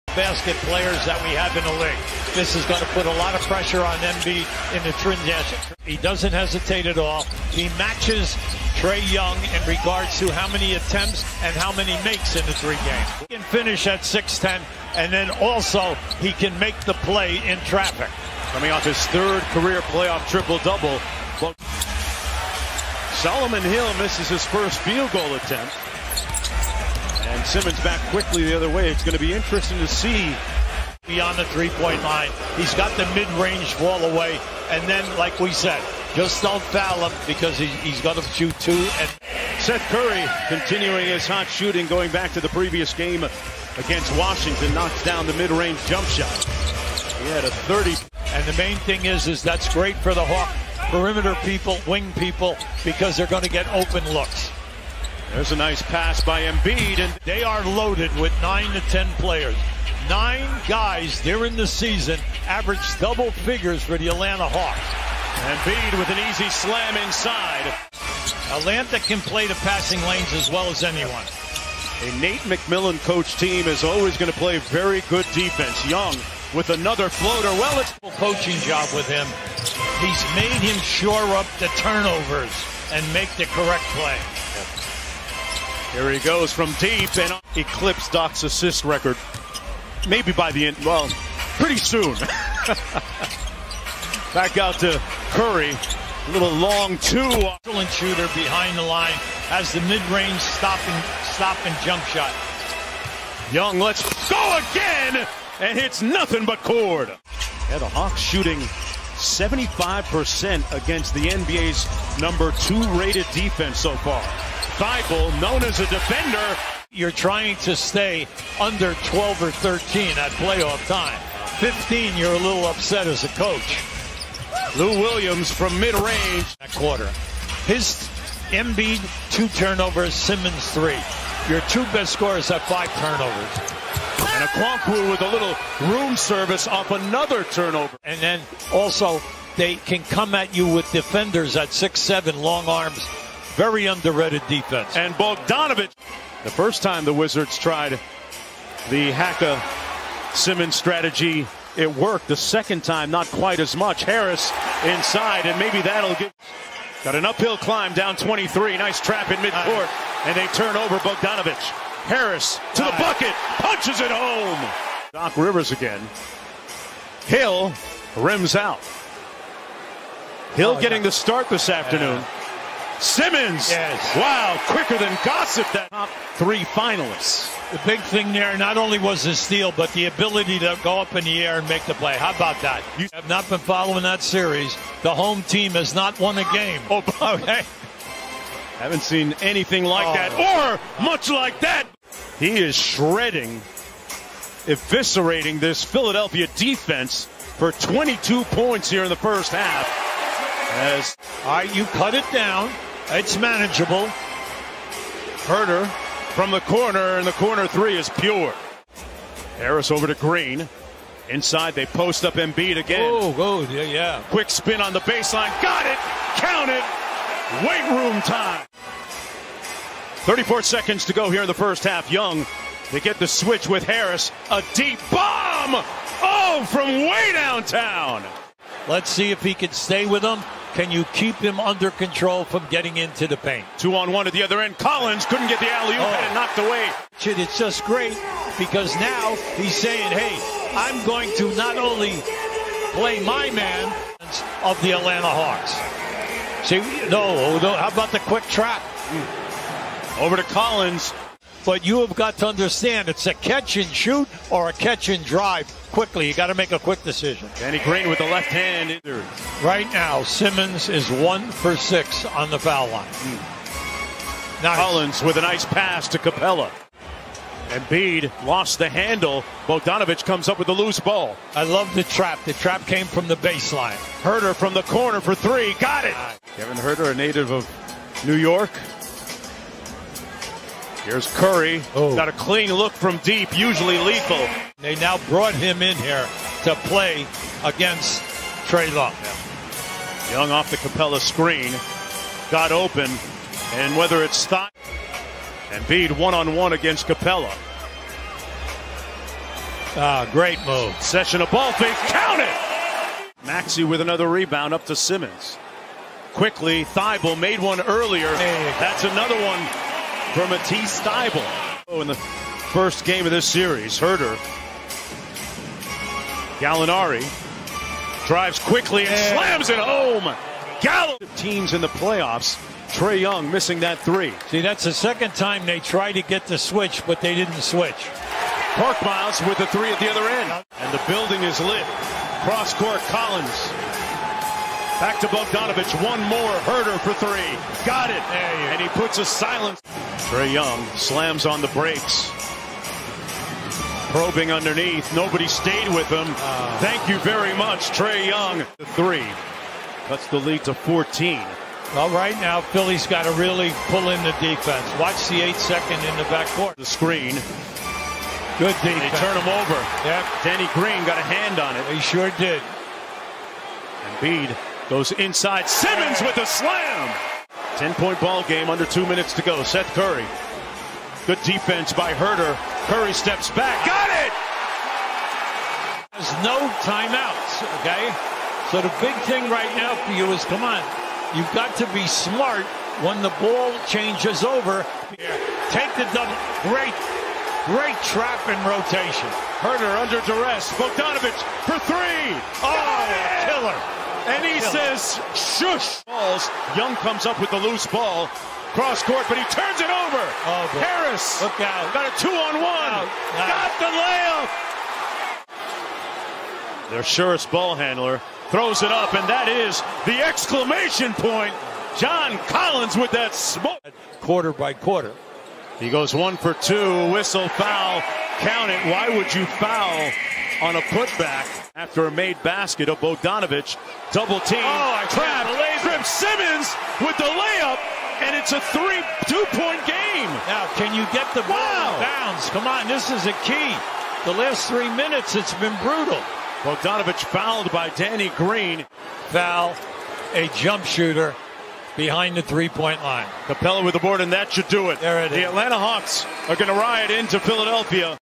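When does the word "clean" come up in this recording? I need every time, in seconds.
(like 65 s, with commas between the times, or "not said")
282 s.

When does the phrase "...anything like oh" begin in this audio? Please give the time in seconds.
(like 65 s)
189 s.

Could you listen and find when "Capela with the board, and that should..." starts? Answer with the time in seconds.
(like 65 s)
443 s.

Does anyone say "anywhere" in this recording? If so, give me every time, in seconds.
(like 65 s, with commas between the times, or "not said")
not said.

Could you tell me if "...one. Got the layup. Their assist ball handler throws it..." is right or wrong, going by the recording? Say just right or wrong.
wrong.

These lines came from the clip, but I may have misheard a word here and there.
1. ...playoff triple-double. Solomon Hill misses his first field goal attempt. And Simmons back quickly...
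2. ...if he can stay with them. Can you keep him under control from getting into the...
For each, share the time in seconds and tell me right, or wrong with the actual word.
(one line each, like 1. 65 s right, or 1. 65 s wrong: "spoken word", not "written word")
1. 19 s right
2. 229 s right.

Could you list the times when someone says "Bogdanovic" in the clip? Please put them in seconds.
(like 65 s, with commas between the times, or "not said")
145 s, 160 s, 269 s, 335 s, 390 s, 422 s, 436 s.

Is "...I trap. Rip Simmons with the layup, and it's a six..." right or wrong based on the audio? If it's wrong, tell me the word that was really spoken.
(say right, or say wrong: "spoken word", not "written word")
wrong: "three", not "six".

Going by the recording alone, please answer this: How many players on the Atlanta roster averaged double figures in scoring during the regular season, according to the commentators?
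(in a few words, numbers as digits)
9.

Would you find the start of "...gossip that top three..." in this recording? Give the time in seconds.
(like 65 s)
175 s.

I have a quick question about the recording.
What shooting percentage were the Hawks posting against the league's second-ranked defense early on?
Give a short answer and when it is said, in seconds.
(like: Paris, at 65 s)
75%, at 109 s.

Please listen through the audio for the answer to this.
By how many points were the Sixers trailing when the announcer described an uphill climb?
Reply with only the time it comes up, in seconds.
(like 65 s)
157 s.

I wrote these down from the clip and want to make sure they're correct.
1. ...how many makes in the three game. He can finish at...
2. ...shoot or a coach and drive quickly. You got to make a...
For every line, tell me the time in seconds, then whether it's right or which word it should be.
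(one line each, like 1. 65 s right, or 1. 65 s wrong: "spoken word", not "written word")
1. 11 s right
2. 253 s wrong: "catch", not "coach".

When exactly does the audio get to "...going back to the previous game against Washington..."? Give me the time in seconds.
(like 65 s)
41 s.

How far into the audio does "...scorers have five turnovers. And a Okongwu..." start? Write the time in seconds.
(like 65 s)
132 s.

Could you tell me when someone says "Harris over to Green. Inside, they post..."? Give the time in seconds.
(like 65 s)
209 s.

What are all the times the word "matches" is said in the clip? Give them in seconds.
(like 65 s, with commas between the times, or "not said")
7 s.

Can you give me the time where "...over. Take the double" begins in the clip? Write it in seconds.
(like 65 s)
384 s.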